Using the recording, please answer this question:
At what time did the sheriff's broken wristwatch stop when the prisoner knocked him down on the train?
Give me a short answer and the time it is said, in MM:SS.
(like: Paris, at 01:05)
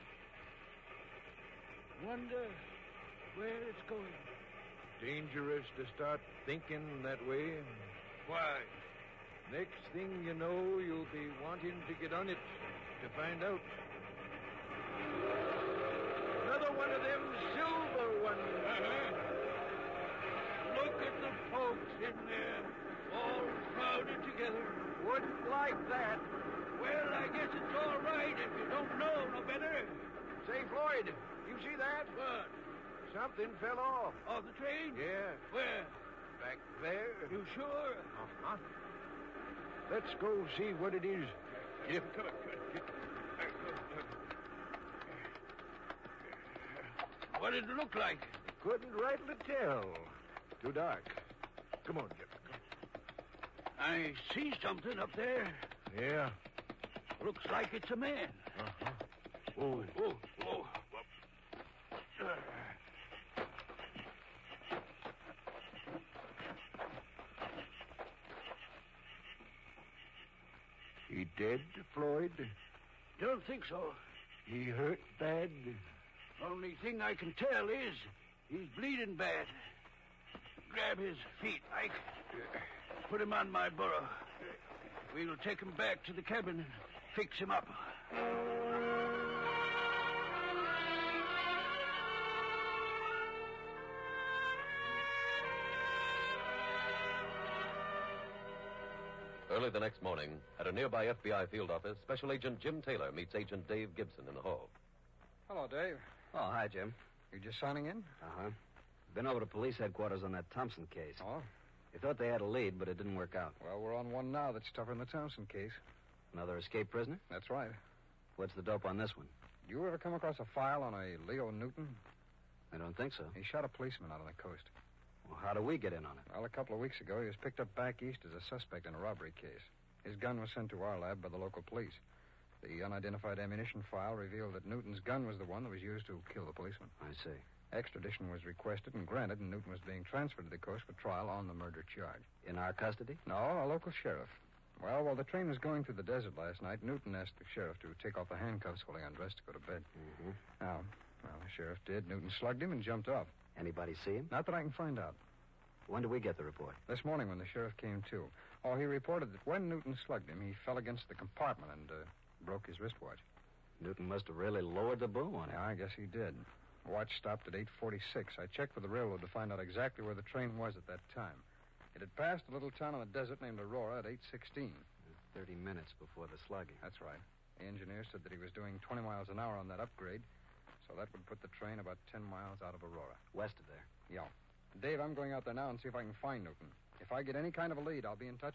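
8:46, at 02:47.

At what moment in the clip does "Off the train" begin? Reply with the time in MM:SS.
00:34.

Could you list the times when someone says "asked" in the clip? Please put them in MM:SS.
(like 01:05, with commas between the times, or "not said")
02:27.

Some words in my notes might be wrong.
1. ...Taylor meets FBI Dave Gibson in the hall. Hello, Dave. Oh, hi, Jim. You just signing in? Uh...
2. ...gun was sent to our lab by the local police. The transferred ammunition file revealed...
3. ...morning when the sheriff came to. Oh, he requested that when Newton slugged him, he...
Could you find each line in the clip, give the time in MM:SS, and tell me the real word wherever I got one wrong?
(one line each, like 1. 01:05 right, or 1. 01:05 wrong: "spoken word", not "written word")
1. 01:42 wrong: "Agent", not "FBI"
2. 02:10 wrong: "unidentified", not "transferred"
3. 02:37 wrong: "reported", not "requested".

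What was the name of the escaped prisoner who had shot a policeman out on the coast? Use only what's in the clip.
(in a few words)
Leo Newton.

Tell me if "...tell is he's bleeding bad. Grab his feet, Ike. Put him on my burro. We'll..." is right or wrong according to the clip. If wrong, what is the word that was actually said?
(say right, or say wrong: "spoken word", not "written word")
right.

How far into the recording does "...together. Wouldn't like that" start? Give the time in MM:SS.
00:24.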